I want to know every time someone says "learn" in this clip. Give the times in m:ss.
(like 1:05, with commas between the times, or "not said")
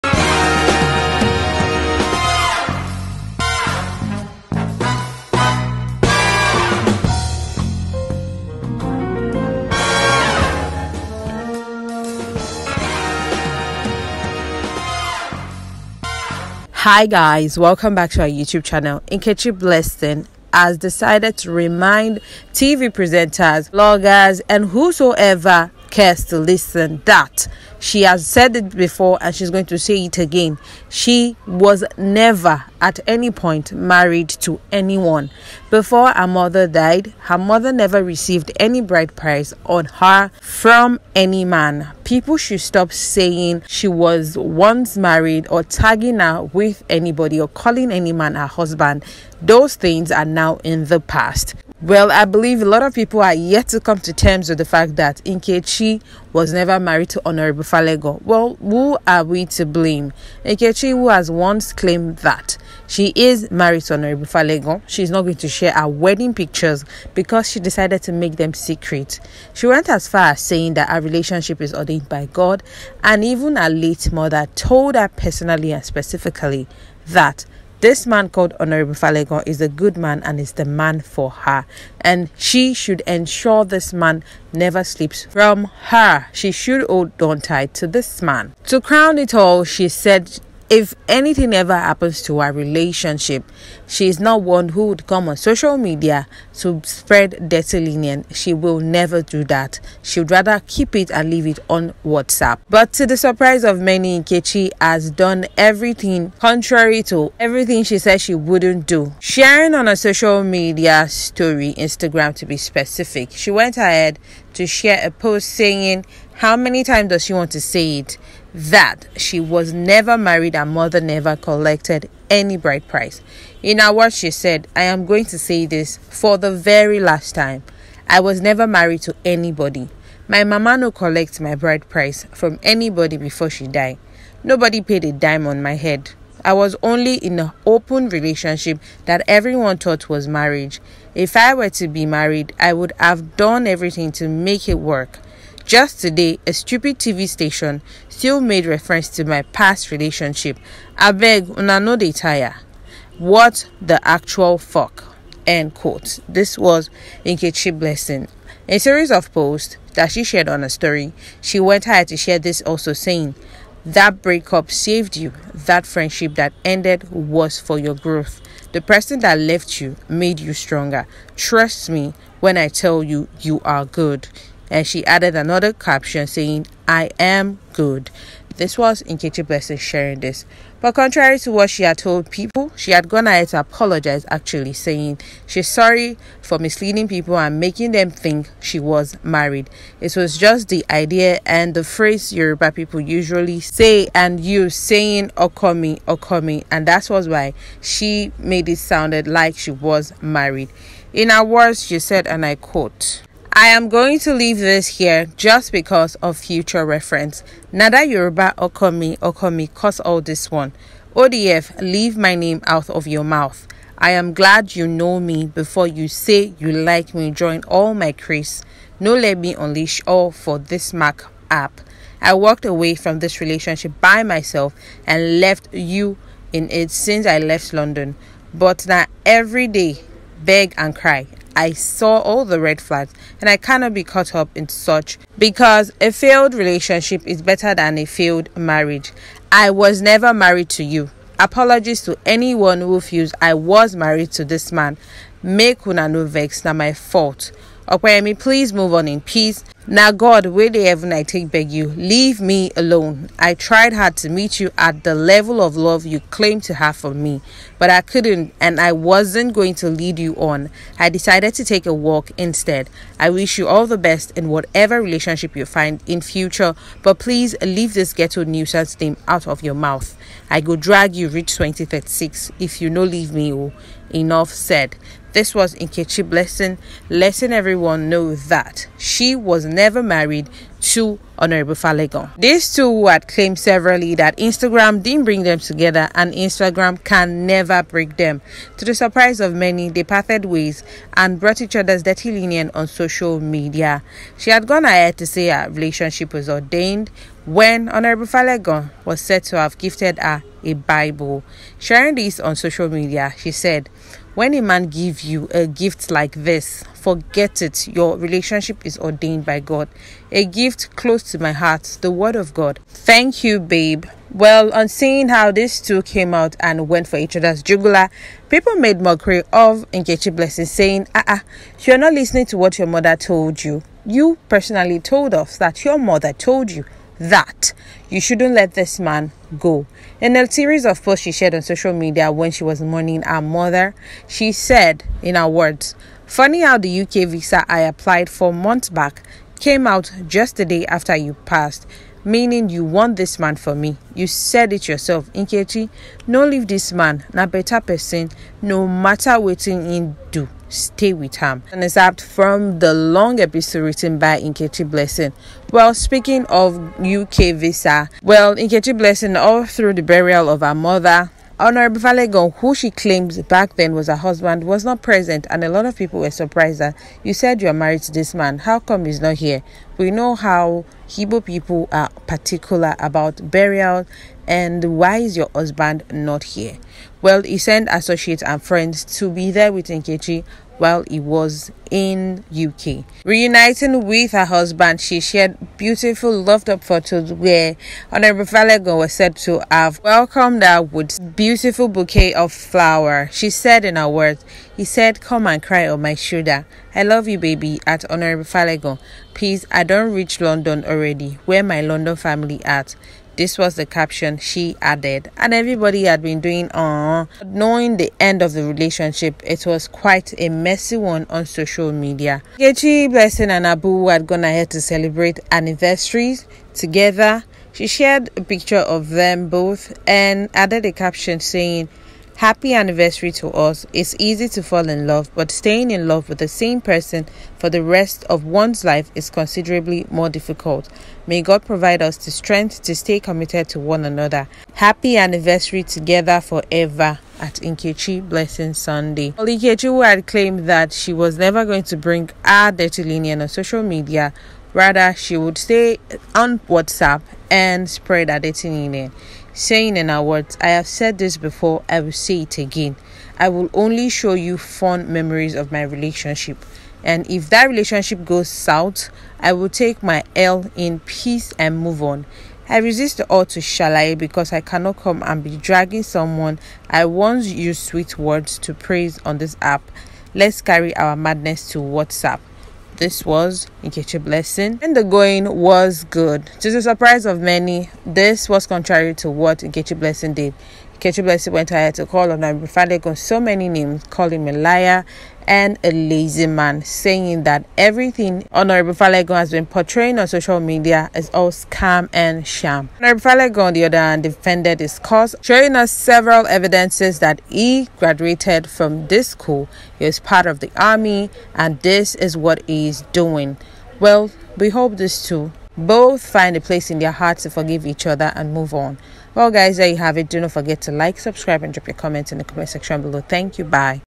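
not said.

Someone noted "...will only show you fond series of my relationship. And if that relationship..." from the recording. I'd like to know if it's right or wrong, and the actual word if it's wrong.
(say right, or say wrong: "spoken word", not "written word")
wrong: "memories", not "series".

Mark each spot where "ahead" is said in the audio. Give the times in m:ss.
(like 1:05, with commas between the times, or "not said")
1:53, 2:41, 3:03, 4:54, 6:54, 8:01.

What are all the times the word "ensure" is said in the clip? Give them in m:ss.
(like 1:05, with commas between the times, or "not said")
1:23.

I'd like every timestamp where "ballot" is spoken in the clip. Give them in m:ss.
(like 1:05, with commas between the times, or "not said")
not said.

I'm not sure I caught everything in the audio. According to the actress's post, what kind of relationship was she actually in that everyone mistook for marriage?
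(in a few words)
An open relationship.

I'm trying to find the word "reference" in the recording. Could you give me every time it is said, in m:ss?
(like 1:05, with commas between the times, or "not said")
2:28, 3:26.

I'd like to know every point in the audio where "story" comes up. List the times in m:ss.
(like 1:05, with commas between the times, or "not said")
1:51, 2:40.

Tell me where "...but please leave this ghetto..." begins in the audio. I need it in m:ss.
4:27.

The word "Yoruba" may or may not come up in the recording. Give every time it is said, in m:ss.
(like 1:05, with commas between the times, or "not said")
3:12, 3:28.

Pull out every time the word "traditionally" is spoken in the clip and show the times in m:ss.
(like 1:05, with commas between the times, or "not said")
not said.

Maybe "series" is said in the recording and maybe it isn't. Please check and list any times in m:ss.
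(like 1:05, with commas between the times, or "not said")
2:38, 5:30.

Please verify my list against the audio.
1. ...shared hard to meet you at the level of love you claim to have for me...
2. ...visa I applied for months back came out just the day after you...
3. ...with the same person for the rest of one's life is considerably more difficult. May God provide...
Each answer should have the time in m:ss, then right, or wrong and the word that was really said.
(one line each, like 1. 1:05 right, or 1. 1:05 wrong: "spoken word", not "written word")
1. 4:13 wrong: "tried", not "shared"
2. 5:37 right
3. 7:06 right.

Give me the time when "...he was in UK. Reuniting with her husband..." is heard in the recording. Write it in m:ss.
6:21.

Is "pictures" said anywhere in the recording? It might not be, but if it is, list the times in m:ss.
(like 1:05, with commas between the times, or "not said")
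1:06, 6:58.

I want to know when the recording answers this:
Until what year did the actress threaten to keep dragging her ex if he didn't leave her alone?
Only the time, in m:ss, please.
4:31.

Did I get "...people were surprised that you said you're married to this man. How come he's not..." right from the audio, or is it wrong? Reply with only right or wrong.
right.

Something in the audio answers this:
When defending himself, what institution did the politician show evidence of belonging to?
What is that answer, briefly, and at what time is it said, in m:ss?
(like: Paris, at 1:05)
The army, at 8:20.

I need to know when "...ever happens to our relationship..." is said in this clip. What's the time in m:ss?
1:31.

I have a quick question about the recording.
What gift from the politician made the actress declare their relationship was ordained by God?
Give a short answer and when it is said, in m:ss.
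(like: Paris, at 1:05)
A Bible, at 5:00.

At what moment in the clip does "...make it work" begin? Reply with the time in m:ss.
2:24.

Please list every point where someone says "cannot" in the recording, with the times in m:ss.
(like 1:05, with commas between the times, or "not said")
3:53, 7:44.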